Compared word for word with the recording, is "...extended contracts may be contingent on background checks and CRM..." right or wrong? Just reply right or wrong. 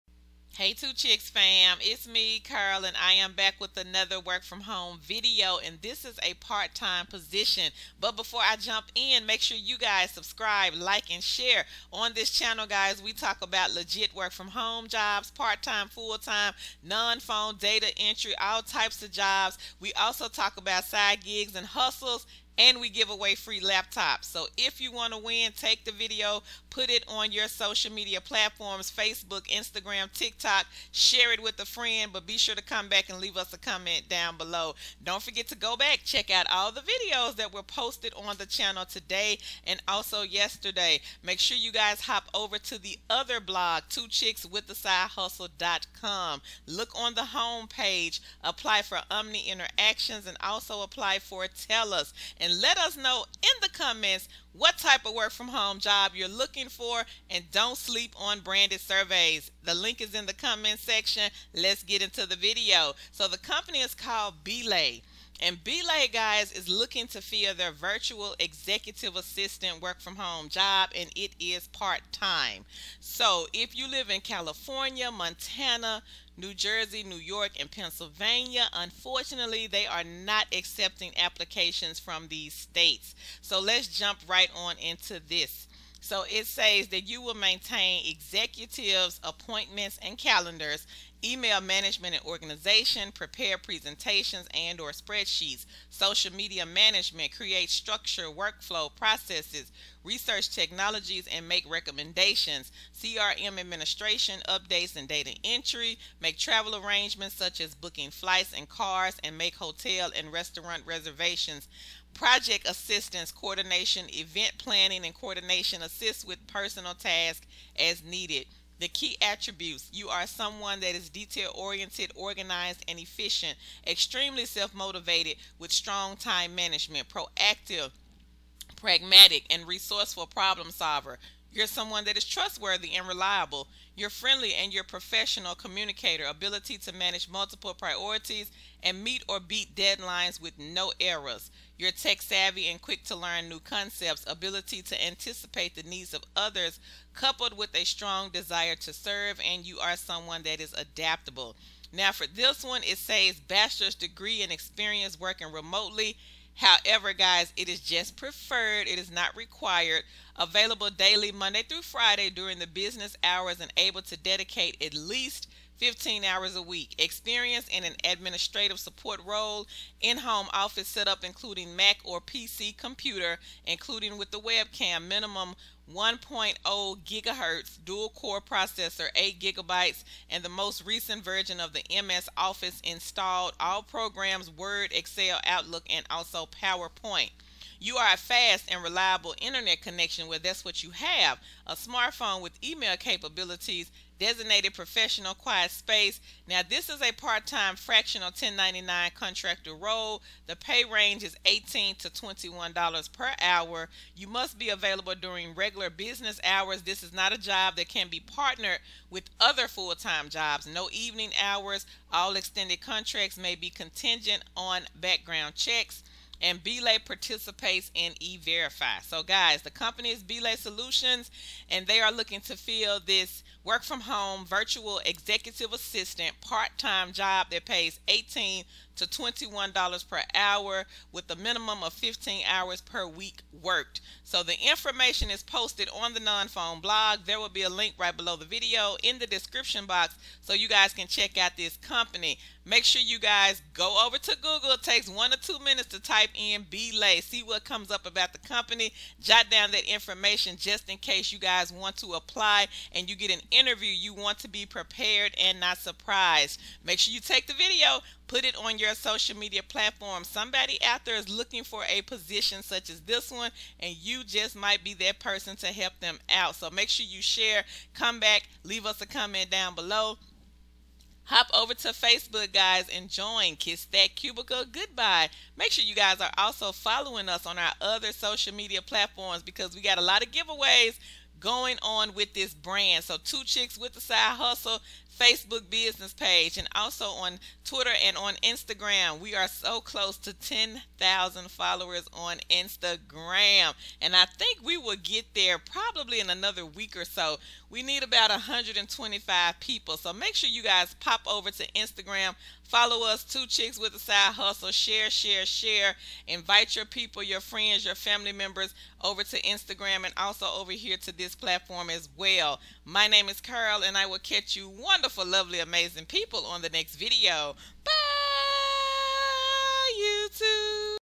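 wrong.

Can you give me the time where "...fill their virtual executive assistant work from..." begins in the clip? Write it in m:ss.
1:07.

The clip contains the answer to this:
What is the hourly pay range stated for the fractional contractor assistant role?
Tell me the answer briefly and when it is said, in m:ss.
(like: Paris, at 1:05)
$18 to $21, at 3:21.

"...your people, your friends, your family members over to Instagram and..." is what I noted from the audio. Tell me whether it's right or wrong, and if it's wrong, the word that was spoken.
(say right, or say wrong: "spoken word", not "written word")
right.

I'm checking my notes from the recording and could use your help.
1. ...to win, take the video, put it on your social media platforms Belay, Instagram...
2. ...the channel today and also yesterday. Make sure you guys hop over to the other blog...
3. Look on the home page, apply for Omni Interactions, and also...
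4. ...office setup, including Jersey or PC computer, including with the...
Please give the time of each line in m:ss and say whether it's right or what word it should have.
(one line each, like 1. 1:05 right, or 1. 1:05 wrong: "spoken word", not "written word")
1. 0:25 wrong: "Facebook", not "Belay"
2. 0:38 right
3. 0:46 right
4. 2:50 wrong: "Mac", not "Jersey".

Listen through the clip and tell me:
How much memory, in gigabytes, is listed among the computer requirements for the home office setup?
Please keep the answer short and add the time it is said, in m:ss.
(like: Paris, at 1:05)
8 gigabytes, at 2:59.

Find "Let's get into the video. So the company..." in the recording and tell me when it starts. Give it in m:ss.
1:01.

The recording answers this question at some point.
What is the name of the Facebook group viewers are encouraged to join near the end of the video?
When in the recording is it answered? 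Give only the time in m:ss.
4:33.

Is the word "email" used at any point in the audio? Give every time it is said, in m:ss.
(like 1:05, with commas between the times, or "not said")
1:31, 3:12.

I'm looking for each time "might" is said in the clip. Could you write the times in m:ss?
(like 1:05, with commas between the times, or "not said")
4:24.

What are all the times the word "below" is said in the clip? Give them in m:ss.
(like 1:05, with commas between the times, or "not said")
0:34, 3:58, 4:29.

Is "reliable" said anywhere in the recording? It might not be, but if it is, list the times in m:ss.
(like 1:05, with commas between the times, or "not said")
2:13, 3:08.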